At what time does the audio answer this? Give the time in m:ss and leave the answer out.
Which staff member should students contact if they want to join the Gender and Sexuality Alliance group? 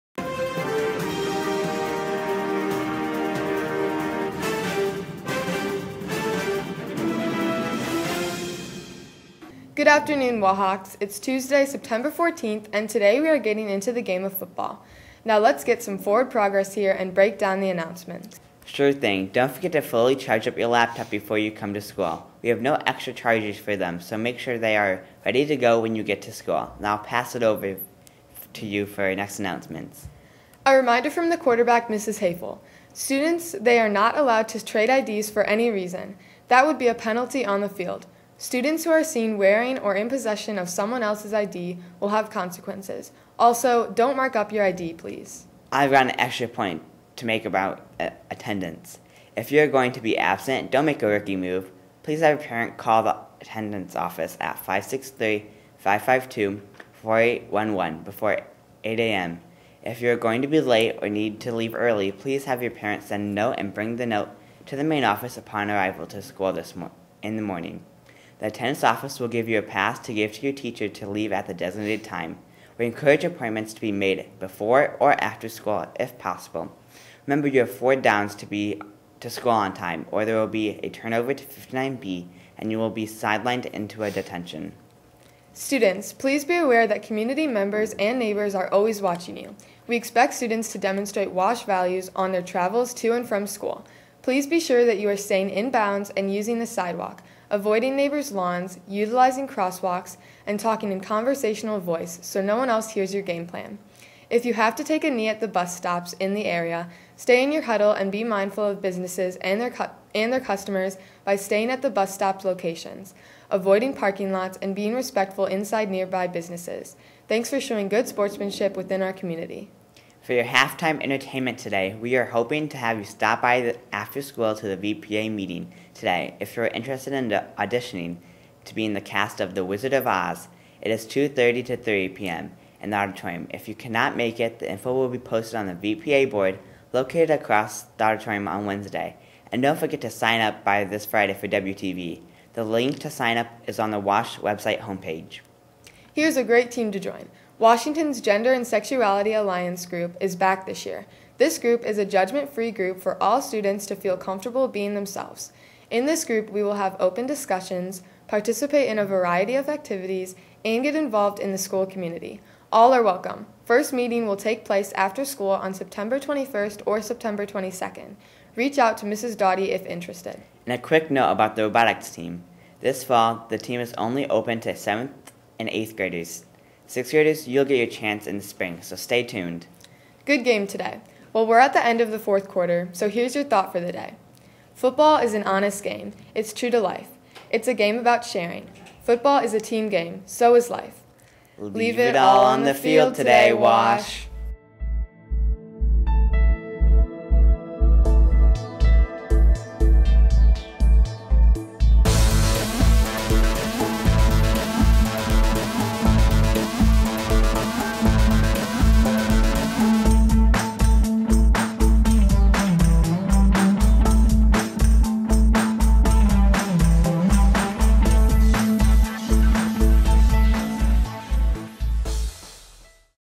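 2:49.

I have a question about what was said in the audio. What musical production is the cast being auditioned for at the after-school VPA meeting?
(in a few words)
The Wizard of Oz.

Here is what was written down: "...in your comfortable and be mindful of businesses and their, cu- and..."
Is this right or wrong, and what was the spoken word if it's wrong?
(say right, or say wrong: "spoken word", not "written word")
wrong: "huddle", not "comfortable".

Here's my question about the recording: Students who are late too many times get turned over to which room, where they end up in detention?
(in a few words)
59B.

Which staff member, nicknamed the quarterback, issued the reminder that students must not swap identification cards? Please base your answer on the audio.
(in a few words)
Mrs. Hafel.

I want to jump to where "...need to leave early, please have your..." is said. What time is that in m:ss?
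1:01.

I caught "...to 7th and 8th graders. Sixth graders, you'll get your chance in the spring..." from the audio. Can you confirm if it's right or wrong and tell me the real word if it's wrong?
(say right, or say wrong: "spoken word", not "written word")
right.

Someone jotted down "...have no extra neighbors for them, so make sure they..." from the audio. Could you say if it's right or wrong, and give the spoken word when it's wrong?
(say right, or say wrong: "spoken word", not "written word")
wrong: "chargers", not "neighbors".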